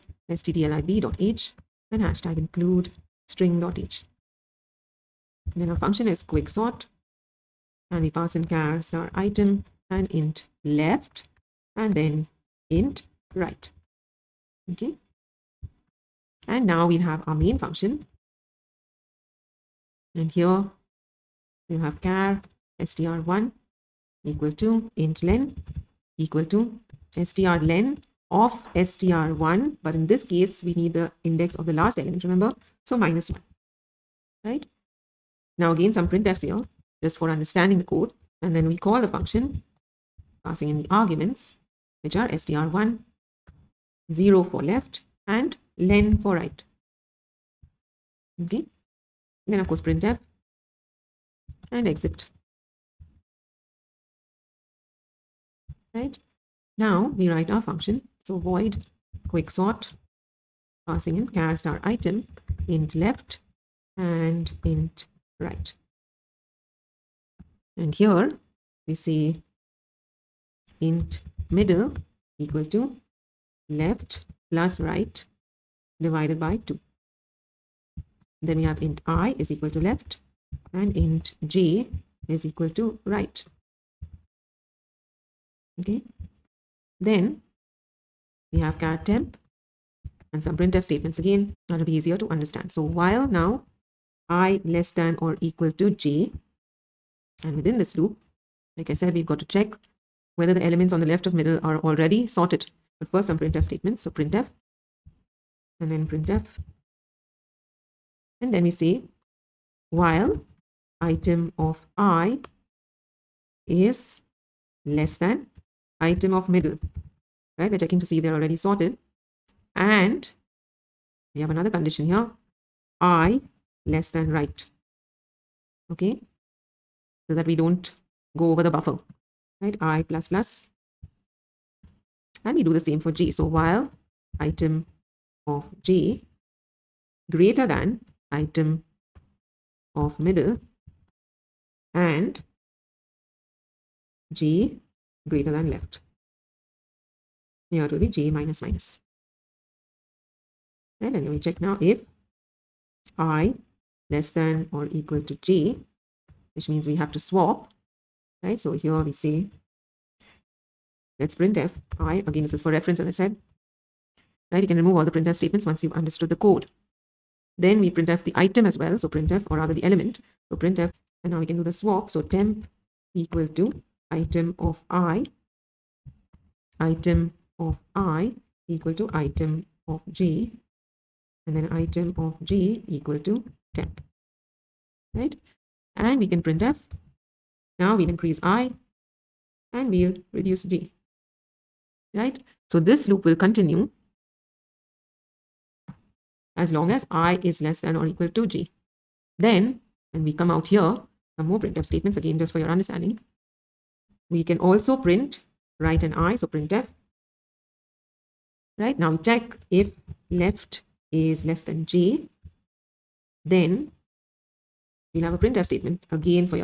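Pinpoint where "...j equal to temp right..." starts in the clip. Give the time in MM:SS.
03:02.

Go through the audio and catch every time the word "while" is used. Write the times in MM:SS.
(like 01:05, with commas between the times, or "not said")
01:32, 01:49, 02:13.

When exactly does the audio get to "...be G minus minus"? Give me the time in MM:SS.
02:27.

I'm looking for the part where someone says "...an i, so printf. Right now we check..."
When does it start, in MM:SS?
03:26.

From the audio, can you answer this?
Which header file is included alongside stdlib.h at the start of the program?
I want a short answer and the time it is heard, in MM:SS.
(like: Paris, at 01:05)
string.h, at 00:03.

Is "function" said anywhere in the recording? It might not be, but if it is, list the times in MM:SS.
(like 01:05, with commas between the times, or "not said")
00:05, 00:17, 00:39, 00:57.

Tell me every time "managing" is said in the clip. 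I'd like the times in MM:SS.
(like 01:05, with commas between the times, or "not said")
not said.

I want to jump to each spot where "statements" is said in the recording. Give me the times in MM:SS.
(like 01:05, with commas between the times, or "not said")
01:30, 01:43, 02:45, 03:21, 03:35.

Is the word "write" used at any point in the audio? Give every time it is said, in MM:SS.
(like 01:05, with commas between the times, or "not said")
00:57, 03:25.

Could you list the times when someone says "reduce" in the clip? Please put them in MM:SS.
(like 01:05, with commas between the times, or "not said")
03:10.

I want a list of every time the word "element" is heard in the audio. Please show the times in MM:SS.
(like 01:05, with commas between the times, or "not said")
00:31, 01:40, 02:49.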